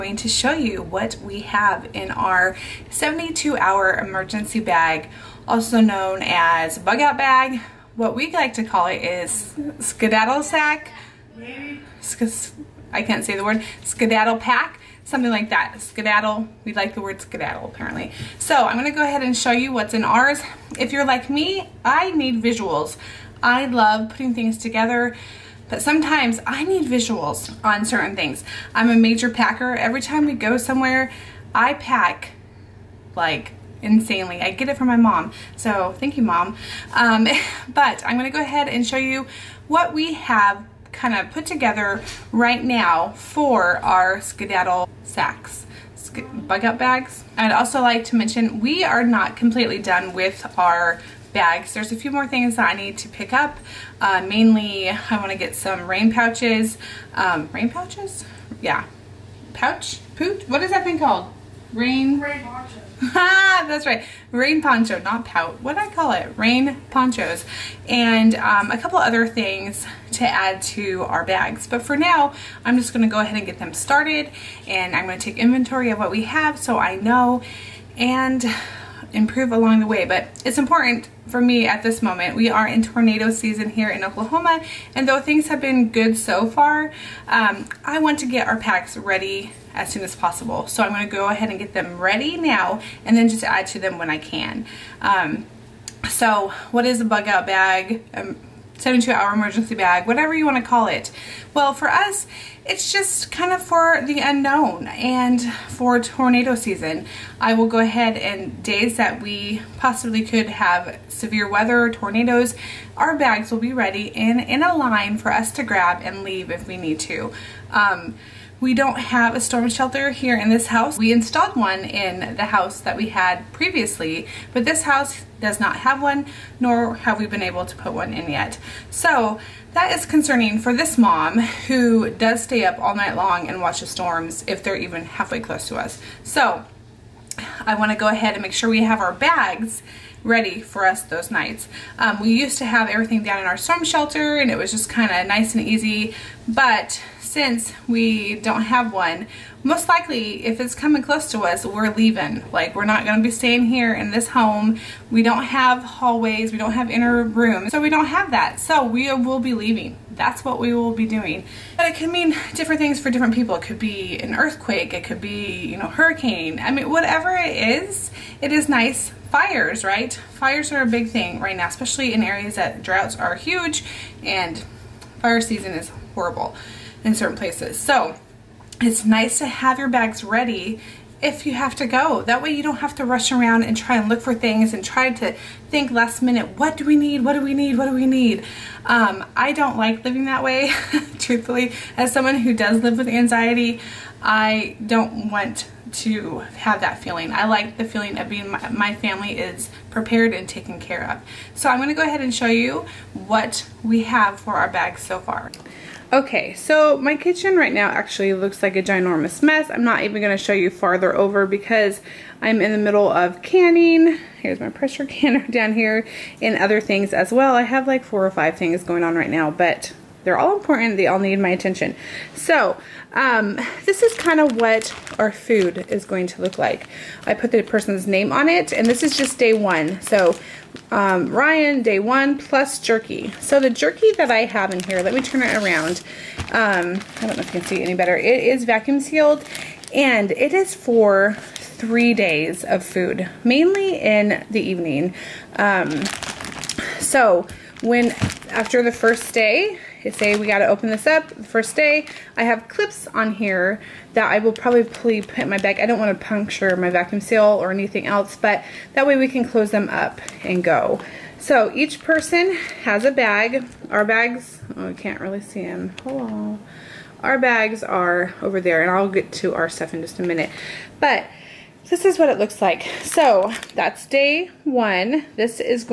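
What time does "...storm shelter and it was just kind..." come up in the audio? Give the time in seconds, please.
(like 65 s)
143 s.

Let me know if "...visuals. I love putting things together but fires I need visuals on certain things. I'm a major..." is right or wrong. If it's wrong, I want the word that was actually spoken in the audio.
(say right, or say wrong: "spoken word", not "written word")
wrong: "sometimes", not "fires".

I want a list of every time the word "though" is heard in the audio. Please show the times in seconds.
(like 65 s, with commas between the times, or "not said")
85 s.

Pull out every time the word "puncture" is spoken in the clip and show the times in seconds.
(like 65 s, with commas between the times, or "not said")
256 s.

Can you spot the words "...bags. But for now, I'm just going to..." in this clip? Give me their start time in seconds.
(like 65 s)
71 s.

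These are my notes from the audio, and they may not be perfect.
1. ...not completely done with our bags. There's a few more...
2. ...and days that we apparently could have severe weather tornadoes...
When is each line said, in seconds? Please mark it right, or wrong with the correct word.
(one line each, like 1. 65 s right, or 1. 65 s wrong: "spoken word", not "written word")
1. 49 s right
2. 108 s wrong: "possibly", not "apparently".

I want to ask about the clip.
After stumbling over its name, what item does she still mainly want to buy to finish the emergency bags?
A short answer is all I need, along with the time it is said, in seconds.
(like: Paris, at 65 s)
Rain ponchos, at 66 s.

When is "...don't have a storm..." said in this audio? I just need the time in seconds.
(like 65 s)
118 s.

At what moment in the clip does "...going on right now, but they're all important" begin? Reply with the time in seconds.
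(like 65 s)
218 s.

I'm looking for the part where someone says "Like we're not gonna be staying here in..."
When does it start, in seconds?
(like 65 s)
152 s.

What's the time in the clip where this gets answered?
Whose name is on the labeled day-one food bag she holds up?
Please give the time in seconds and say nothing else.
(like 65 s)
231 s.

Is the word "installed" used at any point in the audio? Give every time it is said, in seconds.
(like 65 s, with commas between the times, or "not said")
121 s.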